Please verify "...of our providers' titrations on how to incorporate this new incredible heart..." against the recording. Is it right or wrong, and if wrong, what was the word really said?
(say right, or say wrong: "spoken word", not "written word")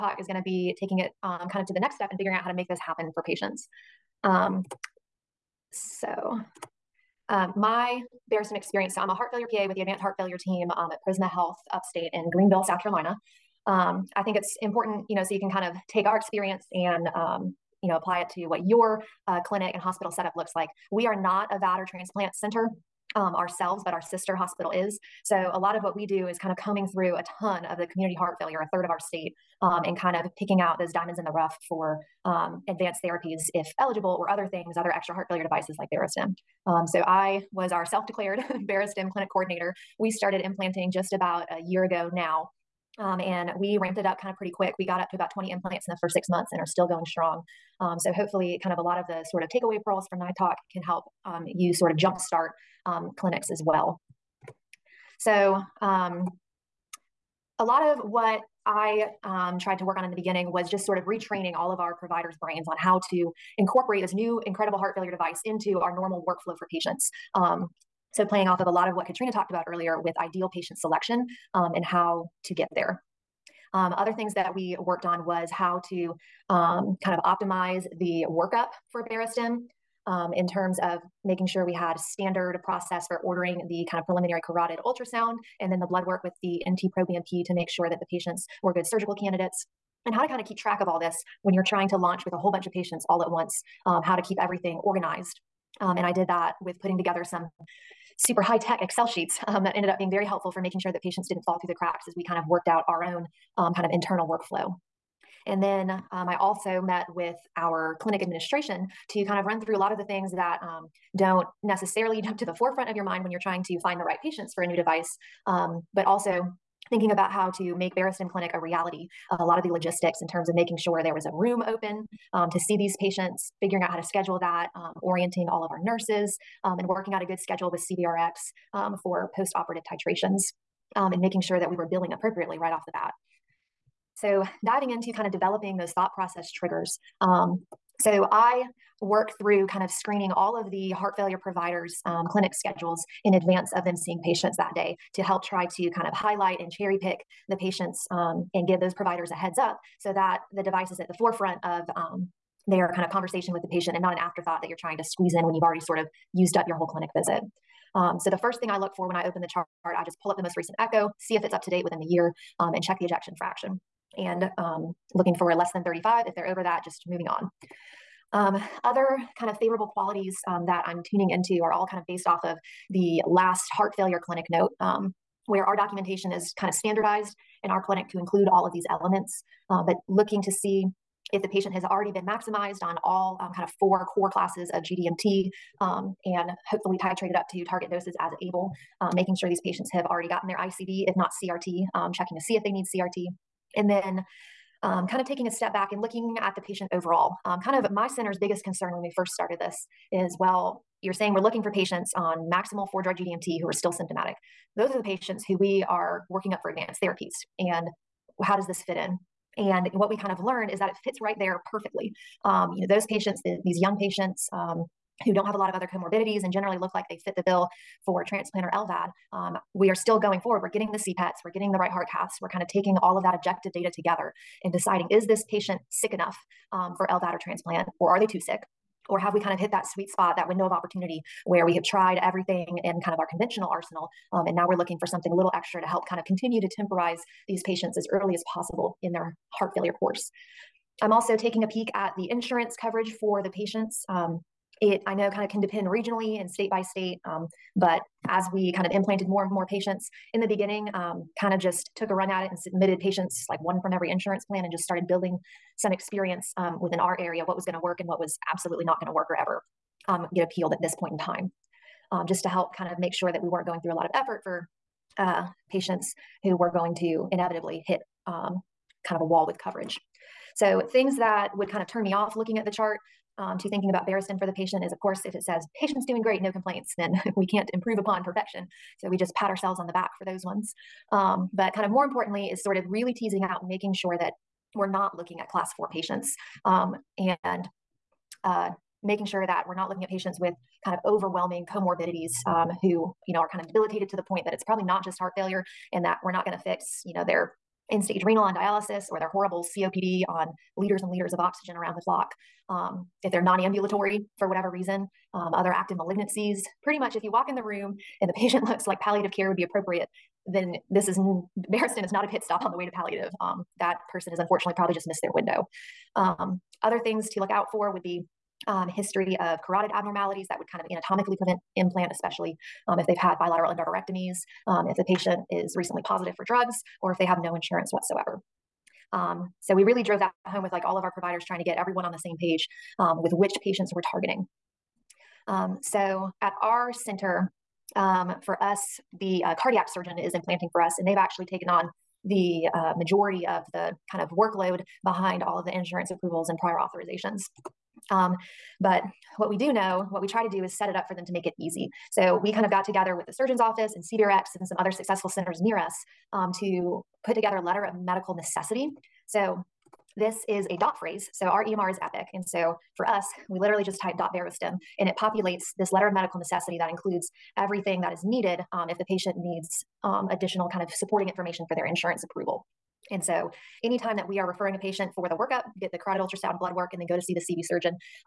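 wrong: "brains", not "titrations".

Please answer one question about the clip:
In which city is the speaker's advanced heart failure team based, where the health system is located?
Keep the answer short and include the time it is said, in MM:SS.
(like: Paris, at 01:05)
Greenville, South Carolina, at 00:12.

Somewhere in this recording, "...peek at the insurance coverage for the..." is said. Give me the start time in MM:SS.
04:01.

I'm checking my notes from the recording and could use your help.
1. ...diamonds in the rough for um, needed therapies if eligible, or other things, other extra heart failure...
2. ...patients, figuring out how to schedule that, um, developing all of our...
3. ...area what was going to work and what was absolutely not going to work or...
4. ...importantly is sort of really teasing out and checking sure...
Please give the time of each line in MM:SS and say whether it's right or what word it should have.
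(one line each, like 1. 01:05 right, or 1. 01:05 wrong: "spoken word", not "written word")
1. 00:30 wrong: "advanced", not "needed"
2. 02:02 wrong: "orienting", not "developing"
3. 04:17 right
4. 04:42 wrong: "making", not "checking".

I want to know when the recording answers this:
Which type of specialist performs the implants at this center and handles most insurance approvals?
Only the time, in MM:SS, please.
05:39.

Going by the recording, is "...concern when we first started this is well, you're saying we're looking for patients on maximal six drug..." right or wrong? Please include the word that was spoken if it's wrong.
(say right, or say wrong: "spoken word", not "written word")
wrong: "four", not "six".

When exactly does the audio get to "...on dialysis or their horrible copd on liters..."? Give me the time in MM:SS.
04:58.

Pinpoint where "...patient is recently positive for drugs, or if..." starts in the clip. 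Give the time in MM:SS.
05:25.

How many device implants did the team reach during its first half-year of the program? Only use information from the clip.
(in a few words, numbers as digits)
20.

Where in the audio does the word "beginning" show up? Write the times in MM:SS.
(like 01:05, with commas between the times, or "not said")
01:00, 04:10.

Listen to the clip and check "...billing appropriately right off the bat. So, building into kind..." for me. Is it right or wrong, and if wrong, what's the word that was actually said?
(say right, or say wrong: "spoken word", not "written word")
wrong: "diving", not "building".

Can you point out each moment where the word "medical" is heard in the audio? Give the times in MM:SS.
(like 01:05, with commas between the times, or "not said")
05:57, 06:06.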